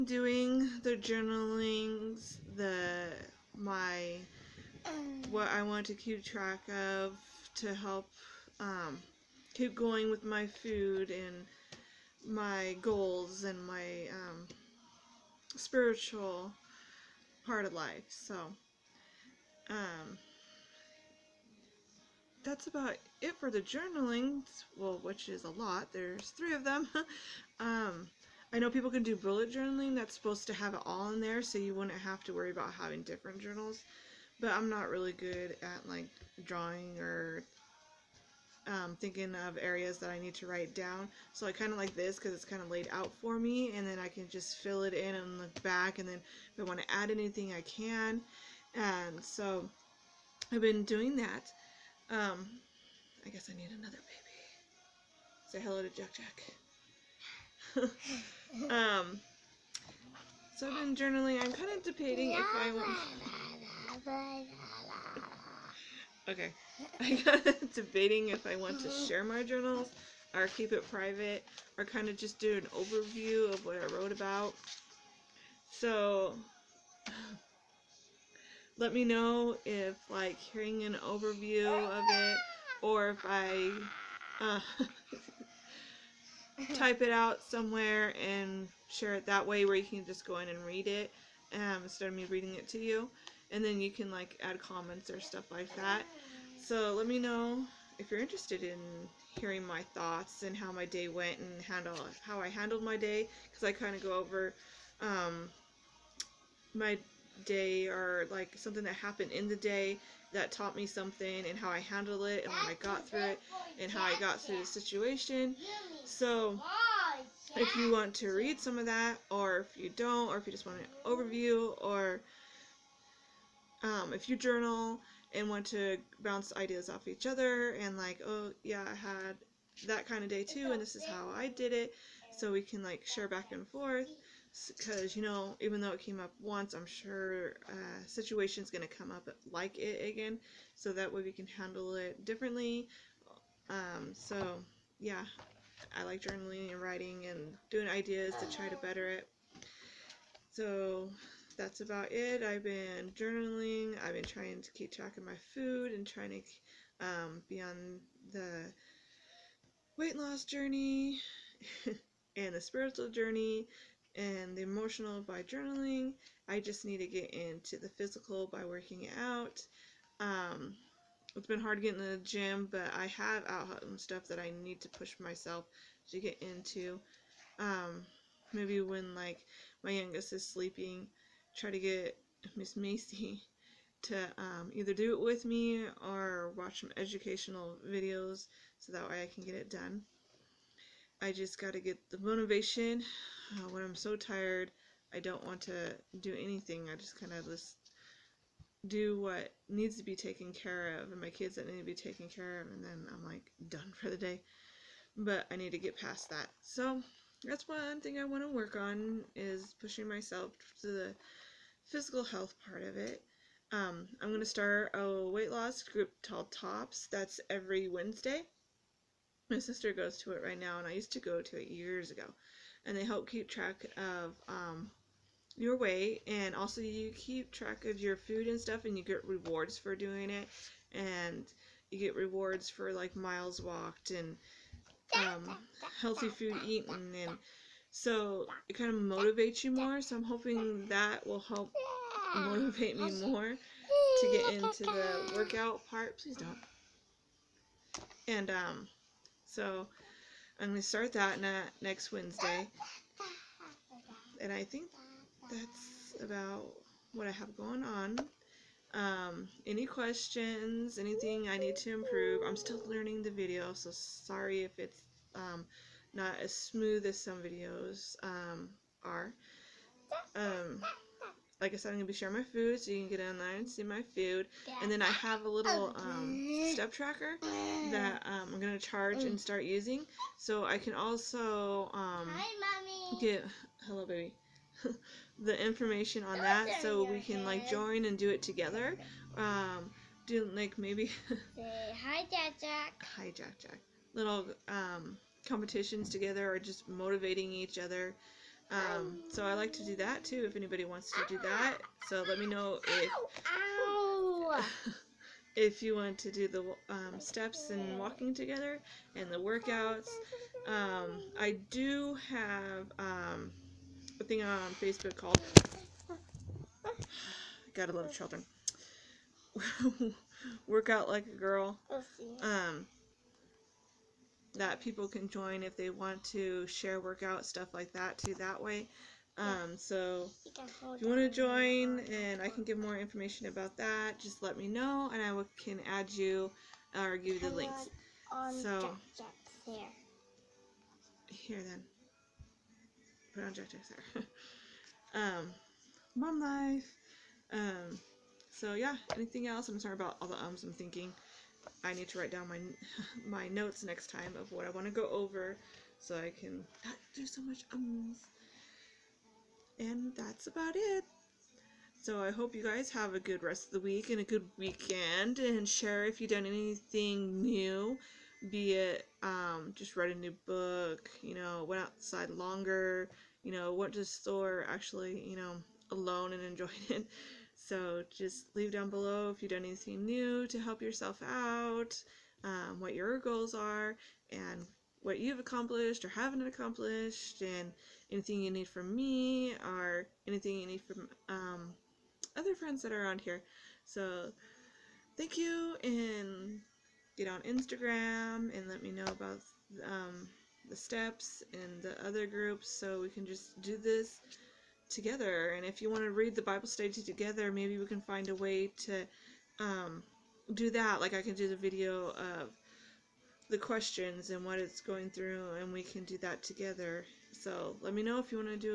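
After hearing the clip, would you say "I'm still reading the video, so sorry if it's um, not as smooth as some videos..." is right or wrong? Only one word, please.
wrong.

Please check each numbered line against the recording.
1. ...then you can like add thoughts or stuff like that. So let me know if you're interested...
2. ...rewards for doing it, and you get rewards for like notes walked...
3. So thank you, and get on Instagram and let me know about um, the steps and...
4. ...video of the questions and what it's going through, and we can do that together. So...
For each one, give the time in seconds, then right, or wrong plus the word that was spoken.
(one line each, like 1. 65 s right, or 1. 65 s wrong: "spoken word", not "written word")
1. 93 s wrong: "comments", not "thoughts"
2. 229 s wrong: "miles", not "notes"
3. 393 s right
4. 411 s right.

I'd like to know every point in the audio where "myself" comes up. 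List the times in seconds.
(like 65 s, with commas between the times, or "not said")
175 s, 210 s.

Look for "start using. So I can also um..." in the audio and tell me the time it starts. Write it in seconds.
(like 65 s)
279 s.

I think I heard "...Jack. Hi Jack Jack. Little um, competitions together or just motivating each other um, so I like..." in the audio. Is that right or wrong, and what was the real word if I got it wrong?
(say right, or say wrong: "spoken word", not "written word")
right.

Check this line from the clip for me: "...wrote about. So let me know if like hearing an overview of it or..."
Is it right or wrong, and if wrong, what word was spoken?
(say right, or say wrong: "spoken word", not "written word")
right.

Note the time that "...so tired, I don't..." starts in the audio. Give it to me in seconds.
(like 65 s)
193 s.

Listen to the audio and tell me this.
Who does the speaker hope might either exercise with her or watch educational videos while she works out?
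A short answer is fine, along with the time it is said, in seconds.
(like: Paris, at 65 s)
Miss Macy, at 182 s.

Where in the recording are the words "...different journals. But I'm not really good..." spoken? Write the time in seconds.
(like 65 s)
33 s.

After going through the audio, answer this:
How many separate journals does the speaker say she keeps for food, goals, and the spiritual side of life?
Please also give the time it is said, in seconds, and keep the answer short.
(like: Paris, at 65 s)
3, at 26 s.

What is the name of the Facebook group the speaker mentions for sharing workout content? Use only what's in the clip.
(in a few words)
Workout Like a Girl.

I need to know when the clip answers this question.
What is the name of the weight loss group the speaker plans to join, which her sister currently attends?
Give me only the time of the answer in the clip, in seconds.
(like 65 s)
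216 s.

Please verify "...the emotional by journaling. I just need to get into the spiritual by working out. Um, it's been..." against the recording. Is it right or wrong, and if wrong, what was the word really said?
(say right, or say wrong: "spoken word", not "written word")
wrong: "physical", not "spiritual".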